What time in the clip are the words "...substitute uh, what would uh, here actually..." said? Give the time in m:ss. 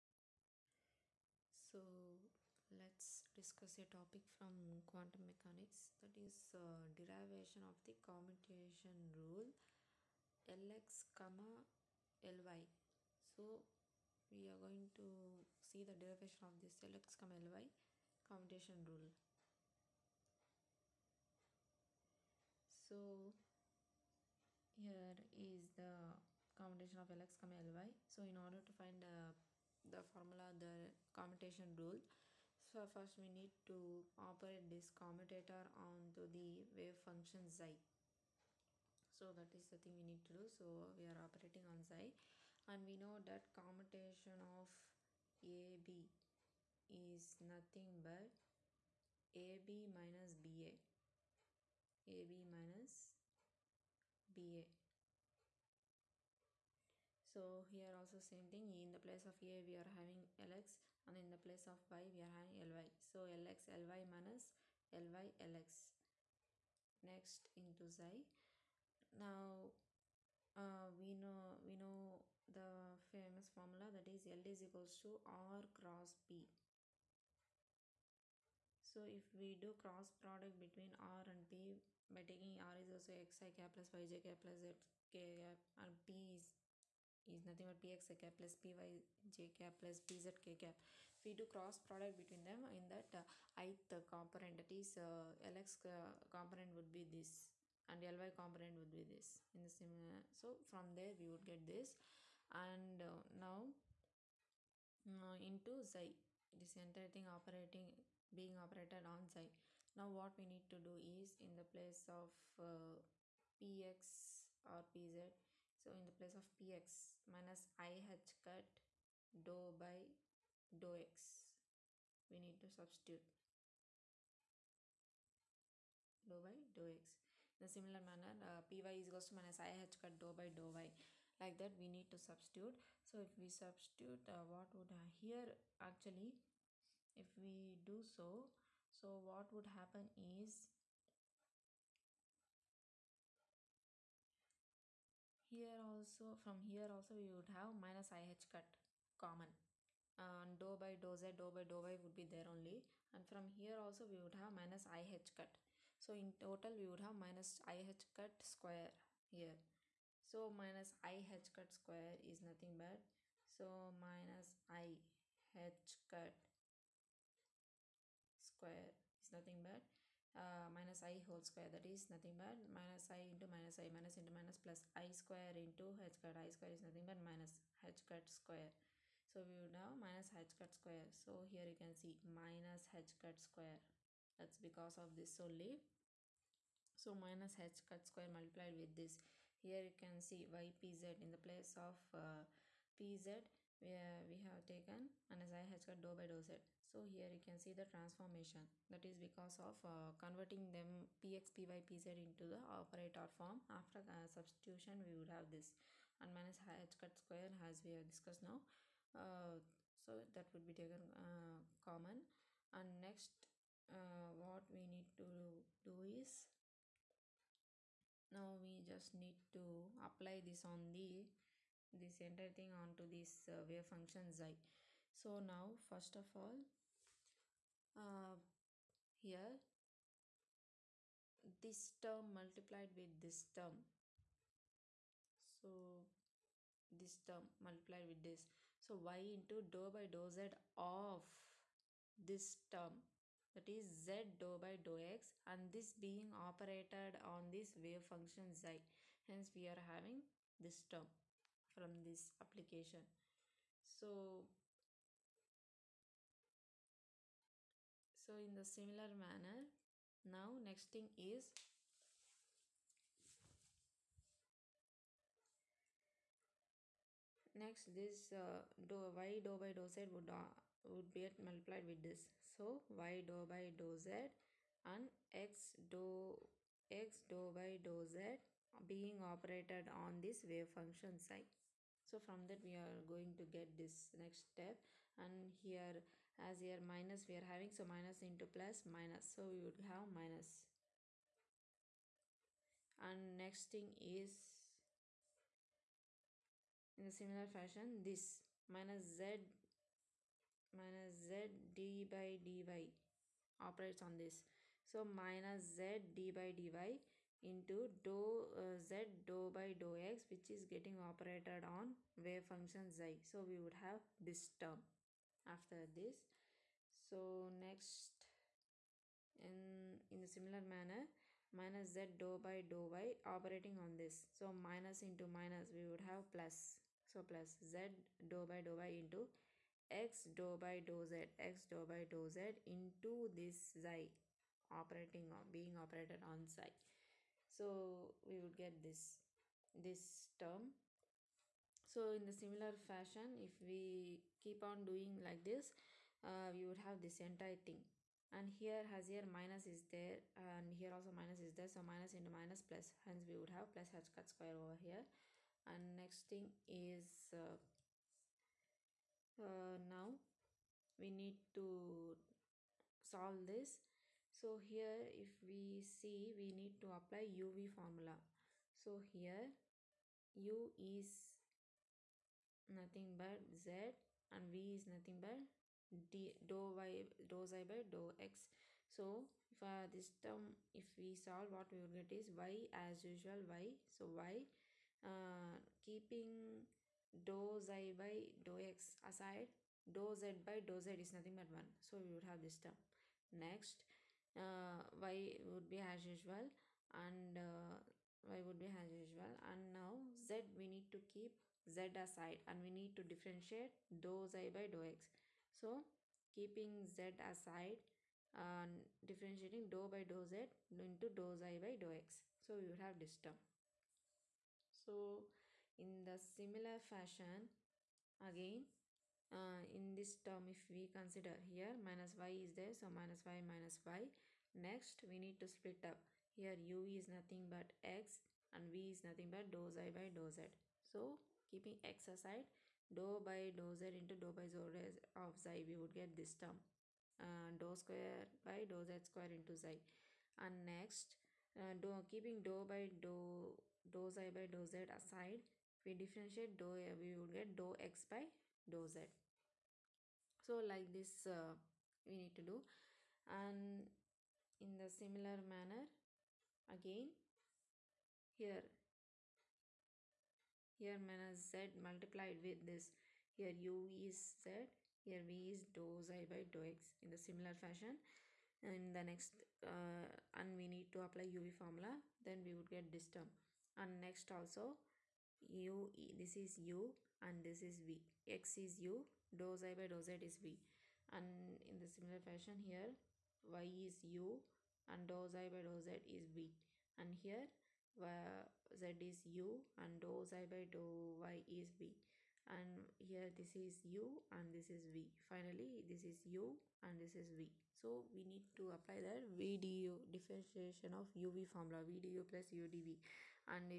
2:13.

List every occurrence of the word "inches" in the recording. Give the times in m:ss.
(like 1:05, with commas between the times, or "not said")
not said.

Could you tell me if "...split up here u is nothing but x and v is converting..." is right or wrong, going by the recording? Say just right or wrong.
wrong.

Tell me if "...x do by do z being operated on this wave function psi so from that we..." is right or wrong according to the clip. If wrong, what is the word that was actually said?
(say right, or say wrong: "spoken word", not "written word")
right.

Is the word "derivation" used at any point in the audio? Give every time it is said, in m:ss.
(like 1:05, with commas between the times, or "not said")
0:06, 0:16.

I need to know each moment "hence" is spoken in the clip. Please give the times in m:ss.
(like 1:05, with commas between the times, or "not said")
4:09, 5:53.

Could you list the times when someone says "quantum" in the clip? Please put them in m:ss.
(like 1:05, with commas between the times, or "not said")
0:04.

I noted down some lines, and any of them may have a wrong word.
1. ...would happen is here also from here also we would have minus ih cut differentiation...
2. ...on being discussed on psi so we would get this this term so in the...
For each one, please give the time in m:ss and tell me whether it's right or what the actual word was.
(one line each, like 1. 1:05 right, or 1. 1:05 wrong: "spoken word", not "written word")
1. 2:19 wrong: "common", not "differentiation"
2. 5:35 wrong: "operated", not "discussed".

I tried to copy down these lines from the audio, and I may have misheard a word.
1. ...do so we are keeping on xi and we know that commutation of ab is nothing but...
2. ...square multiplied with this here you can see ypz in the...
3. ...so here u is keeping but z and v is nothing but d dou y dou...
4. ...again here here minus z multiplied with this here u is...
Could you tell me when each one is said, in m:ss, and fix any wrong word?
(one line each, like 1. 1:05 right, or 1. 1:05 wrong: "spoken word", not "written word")
1. 0:40 wrong: "operating", not "keeping"
2. 3:08 right
3. 6:08 wrong: "nothing", not "keeping"
4. 7:36 right.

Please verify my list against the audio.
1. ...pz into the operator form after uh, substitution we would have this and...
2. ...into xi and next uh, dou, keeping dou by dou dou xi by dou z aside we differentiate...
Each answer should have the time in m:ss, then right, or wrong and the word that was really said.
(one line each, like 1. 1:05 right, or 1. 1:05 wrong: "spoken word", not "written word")
1. 3:21 right
2. 7:19 right.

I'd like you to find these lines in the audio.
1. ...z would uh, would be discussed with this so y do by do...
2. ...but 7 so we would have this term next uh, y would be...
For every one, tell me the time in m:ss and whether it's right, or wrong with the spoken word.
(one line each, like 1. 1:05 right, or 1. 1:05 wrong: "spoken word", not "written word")
1. 4:29 wrong: "multiplied", not "discussed"
2. 6:31 wrong: "1", not "7".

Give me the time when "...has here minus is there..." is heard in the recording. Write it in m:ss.
5:48.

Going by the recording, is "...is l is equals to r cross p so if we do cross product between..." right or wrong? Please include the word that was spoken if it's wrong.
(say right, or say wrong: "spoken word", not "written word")
right.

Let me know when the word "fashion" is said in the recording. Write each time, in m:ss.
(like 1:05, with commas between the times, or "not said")
4:57, 5:42, 6:56, 7:47, 8:02.